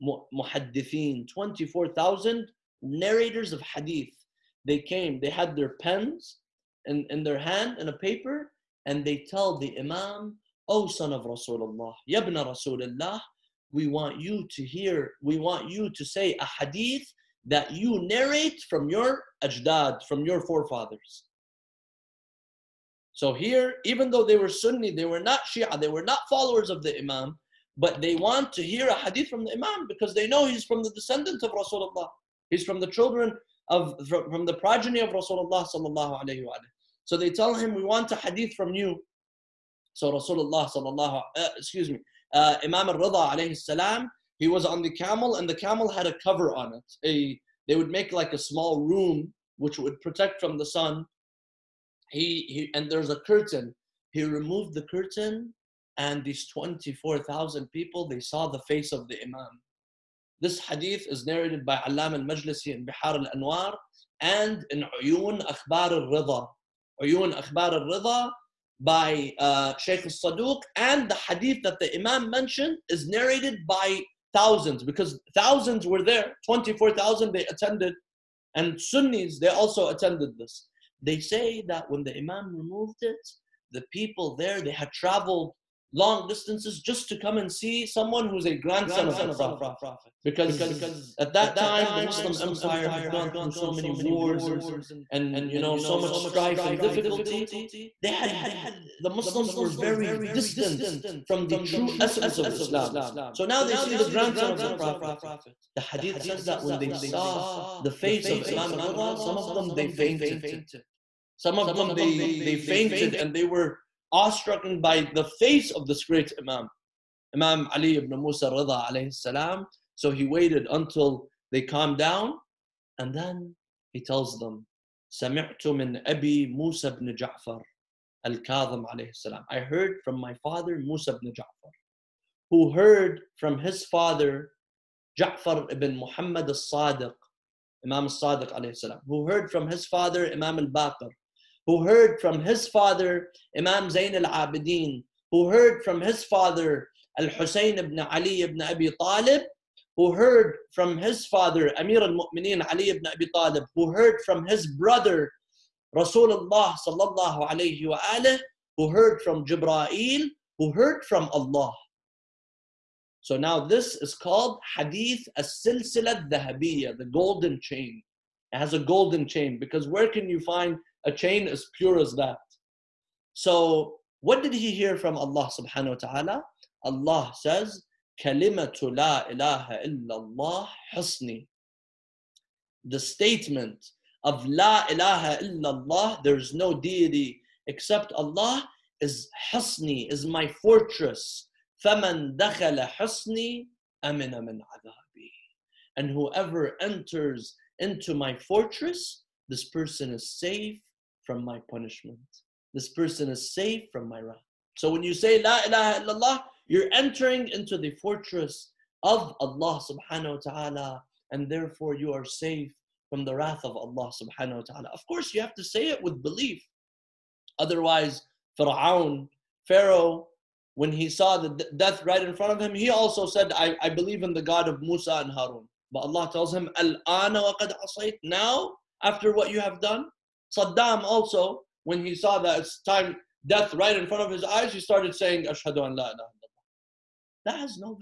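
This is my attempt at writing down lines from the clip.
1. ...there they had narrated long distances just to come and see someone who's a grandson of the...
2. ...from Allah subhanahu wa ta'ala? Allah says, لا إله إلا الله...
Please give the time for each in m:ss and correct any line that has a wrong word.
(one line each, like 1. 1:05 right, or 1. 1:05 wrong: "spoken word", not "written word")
1. 1:24 wrong: "traveled", not "narrated"
2. 2:54 right.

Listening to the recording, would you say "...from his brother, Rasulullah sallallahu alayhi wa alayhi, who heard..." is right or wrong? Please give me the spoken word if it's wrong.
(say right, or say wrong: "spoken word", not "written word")
right.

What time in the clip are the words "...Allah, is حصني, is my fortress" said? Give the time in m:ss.
3:08.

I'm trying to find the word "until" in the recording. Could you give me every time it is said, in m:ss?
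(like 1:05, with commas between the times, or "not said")
2:00.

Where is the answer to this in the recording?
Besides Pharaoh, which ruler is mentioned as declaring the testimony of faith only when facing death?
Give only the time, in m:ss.
3:50.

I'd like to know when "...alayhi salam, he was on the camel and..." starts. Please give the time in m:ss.
0:43.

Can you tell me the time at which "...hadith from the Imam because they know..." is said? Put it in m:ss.
0:28.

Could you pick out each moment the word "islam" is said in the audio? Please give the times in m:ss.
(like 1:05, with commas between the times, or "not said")
1:42.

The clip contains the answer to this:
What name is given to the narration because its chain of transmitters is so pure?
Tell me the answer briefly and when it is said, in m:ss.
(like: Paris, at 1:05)
Hadith as-Silsilat Dhahabiyya, at 2:44.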